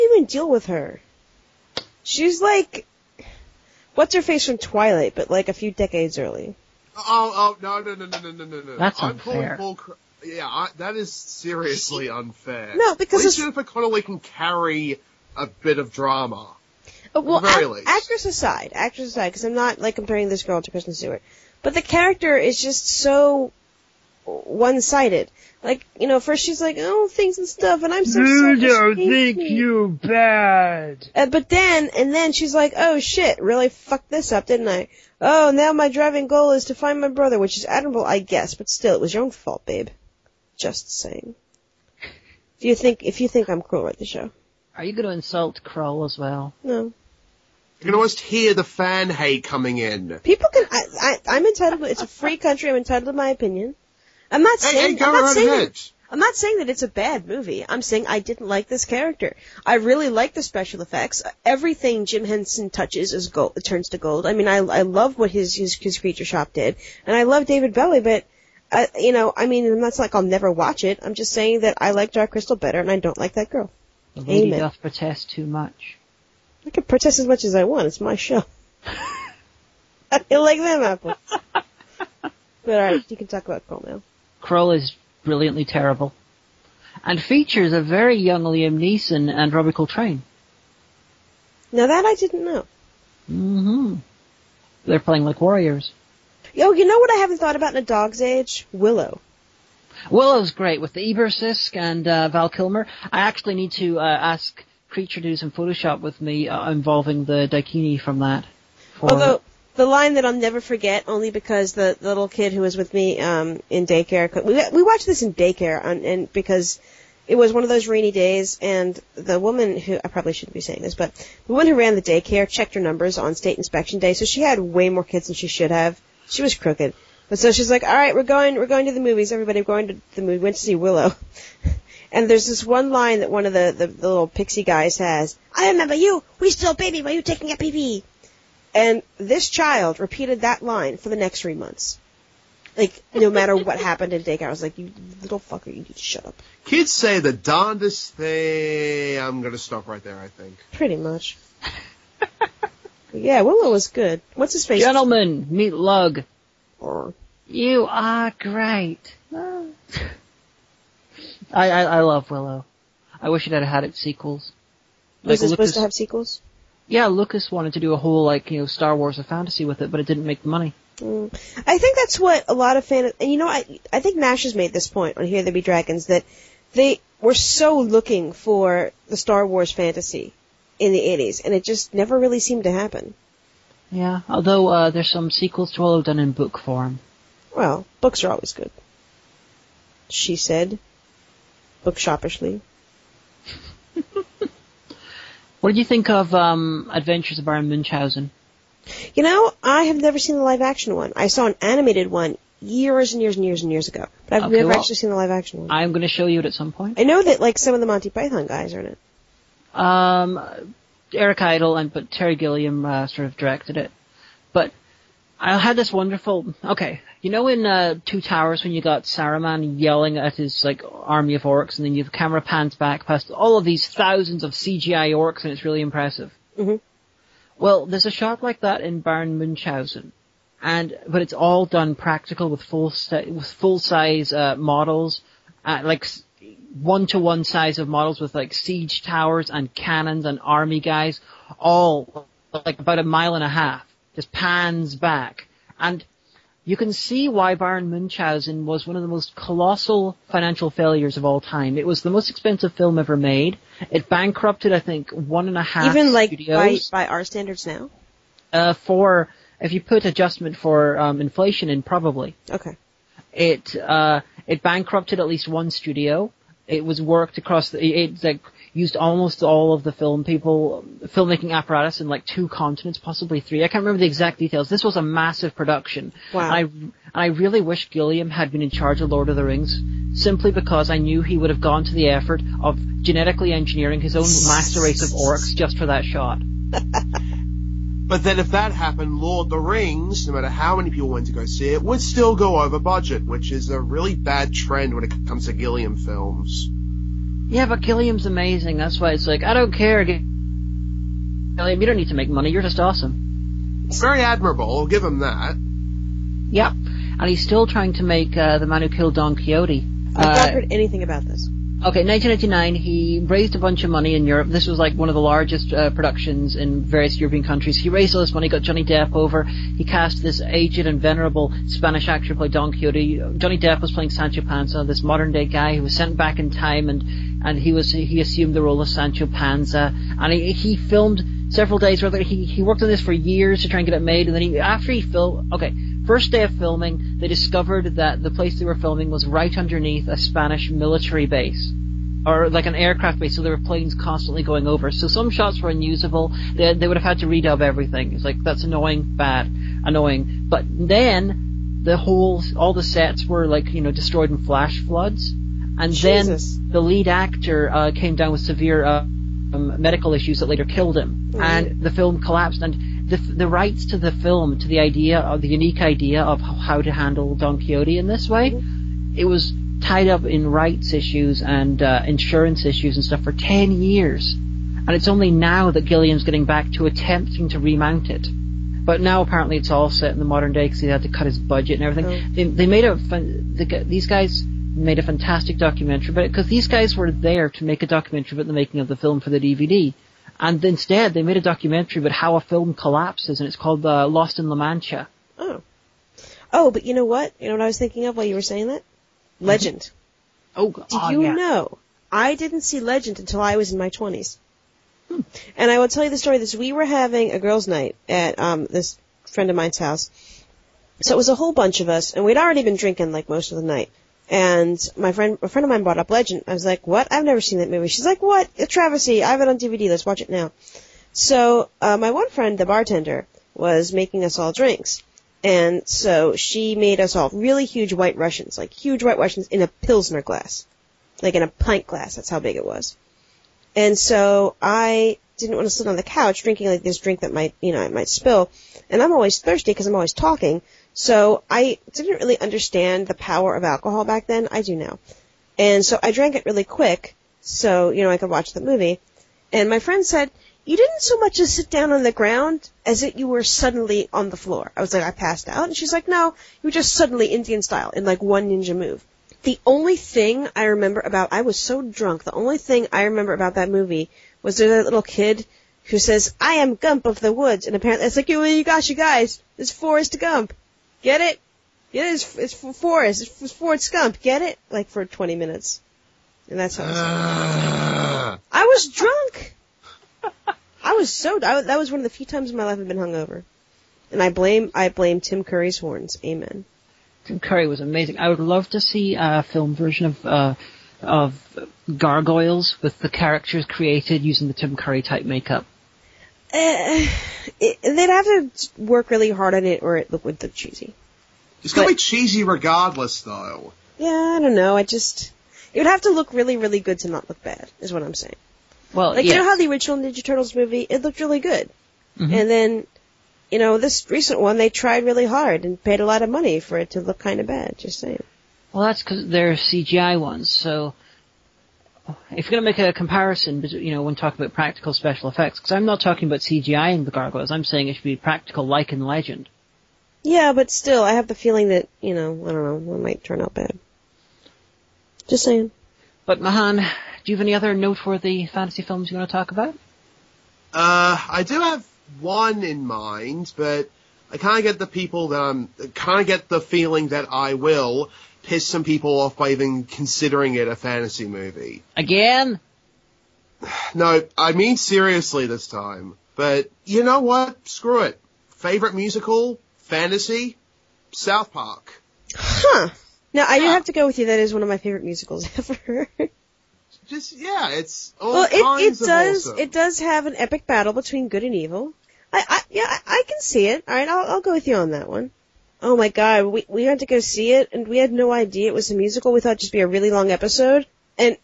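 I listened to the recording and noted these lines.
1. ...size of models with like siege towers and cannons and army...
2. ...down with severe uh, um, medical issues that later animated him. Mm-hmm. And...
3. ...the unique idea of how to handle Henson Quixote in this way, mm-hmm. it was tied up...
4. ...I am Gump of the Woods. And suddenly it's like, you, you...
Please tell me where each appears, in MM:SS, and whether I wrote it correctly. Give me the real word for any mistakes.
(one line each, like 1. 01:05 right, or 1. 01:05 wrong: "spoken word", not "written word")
1. 03:57 right
2. 05:58 wrong: "killed", not "animated"
3. 06:05 wrong: "Don", not "Henson"
4. 07:46 wrong: "apparently", not "suddenly".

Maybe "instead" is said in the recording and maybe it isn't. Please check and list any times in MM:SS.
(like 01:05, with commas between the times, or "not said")
06:30.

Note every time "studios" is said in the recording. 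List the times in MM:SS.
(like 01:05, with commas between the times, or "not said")
04:16, 04:25.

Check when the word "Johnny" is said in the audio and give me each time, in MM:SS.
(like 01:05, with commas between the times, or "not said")
05:18, 05:23.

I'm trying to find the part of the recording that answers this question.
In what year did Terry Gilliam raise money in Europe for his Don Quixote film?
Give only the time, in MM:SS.
05:12.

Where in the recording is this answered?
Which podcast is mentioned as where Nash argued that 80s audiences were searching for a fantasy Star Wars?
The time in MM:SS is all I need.
02:55.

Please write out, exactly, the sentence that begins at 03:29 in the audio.
Um, Eric Idle and but Terry Gilliam uh, sort of directed it.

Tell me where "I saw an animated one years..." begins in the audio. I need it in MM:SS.
03:21.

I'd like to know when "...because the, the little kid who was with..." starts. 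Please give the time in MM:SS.
01:51.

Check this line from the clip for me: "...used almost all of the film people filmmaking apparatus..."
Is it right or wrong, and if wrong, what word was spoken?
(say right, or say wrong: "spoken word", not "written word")
right.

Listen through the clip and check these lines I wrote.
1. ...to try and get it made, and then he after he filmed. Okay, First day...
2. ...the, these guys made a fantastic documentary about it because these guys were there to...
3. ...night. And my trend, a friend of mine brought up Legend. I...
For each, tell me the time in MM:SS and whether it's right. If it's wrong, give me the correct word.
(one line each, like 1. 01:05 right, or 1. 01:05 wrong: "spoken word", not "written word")
1. 05:33 right
2. 06:23 right
3. 06:53 wrong: "friend", not "trend".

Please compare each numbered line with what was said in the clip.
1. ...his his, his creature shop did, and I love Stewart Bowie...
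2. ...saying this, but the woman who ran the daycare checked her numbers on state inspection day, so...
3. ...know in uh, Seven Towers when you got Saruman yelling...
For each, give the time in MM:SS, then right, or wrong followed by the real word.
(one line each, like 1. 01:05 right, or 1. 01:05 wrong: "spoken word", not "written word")
1. 01:05 wrong: "David", not "Stewart"
2. 02:00 right
3. 03:37 wrong: "Two", not "Seven".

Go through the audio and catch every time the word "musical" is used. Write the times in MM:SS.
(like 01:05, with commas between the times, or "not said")
09:18, 09:25, 09:38.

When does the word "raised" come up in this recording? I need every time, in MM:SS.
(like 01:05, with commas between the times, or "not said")
05:13, 05:17.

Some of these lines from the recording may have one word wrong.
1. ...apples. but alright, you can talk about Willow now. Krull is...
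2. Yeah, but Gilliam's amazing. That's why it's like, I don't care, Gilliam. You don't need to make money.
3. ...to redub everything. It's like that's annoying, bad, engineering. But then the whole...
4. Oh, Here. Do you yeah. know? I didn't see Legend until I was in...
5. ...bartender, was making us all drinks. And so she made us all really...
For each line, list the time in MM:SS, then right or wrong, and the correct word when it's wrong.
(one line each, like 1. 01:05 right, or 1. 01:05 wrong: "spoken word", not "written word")
1. 01:20 wrong: "Krull", not "Willow"
2. 04:57 right
3. 05:47 wrong: "annoying", not "engineering"
4. 06:40 wrong: "God", not "Here"
5. 07:02 right.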